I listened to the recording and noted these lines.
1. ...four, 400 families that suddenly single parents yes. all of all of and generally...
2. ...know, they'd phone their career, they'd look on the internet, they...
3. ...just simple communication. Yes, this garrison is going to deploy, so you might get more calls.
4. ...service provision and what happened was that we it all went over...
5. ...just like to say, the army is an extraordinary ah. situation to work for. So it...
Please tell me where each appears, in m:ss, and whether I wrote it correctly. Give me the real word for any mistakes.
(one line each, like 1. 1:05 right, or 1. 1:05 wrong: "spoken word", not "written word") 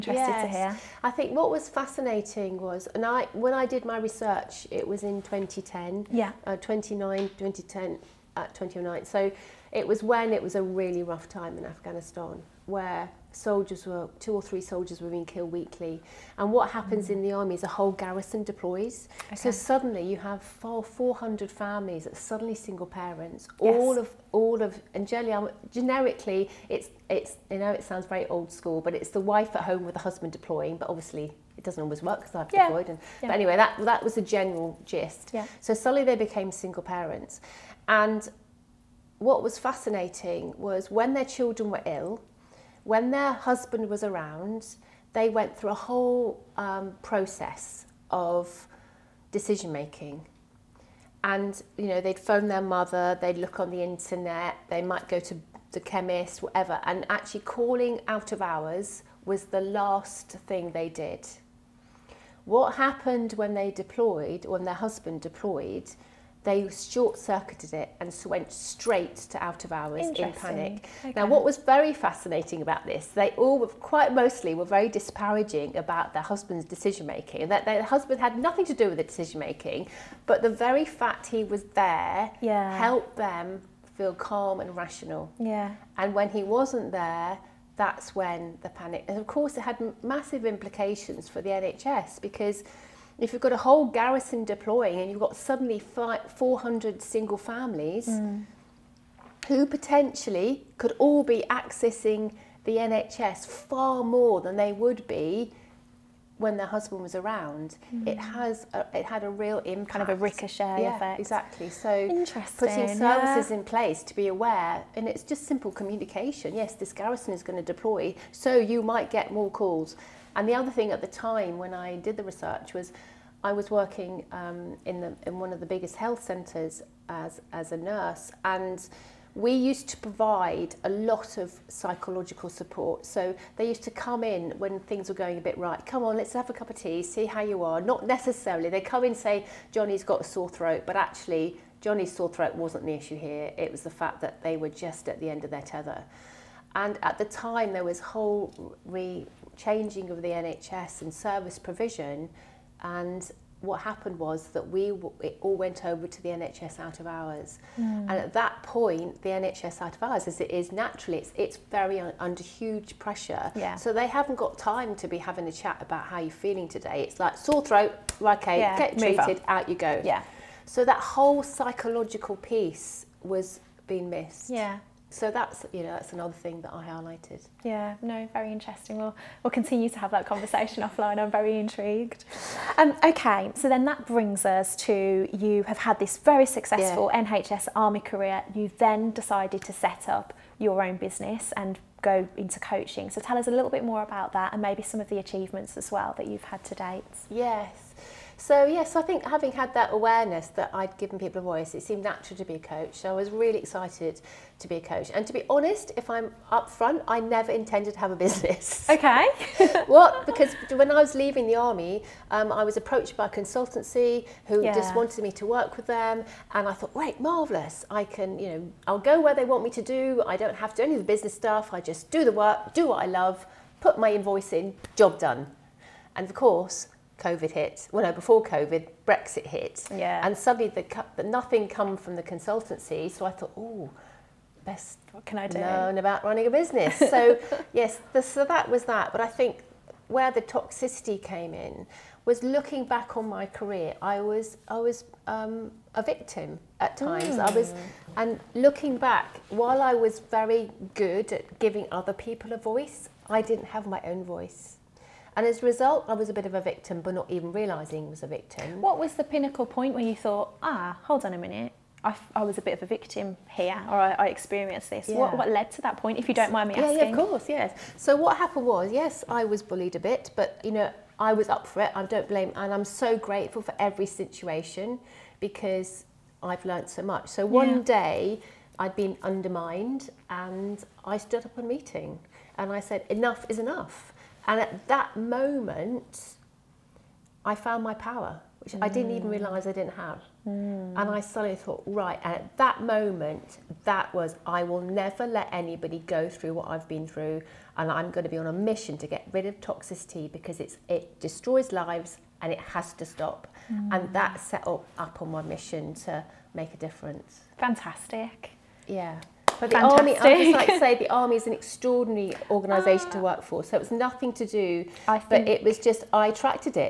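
1. 0:20 right
2. 0:51 wrong: "mother", not "career"
3. 1:55 right
4. 2:31 right
5. 5:10 wrong: "organisation", not "situation".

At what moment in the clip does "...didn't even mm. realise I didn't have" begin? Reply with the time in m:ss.
4:48.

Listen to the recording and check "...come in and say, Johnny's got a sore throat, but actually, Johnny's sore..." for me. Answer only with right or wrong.
right.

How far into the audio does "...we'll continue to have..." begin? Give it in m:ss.
2:59.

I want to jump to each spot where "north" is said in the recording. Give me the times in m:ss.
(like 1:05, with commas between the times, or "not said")
not said.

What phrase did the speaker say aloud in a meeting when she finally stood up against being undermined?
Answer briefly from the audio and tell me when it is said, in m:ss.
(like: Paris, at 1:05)
Enough is enough, at 4:43.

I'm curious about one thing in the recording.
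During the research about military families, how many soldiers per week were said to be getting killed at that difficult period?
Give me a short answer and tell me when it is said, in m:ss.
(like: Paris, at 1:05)
2 or 3, at 0:14.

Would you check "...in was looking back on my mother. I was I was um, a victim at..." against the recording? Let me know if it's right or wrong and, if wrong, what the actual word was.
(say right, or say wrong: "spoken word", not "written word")
wrong: "career", not "mother".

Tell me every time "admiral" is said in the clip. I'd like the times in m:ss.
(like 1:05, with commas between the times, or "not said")
not said.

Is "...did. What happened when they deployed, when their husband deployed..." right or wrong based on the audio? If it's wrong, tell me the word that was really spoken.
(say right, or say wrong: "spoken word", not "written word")
right.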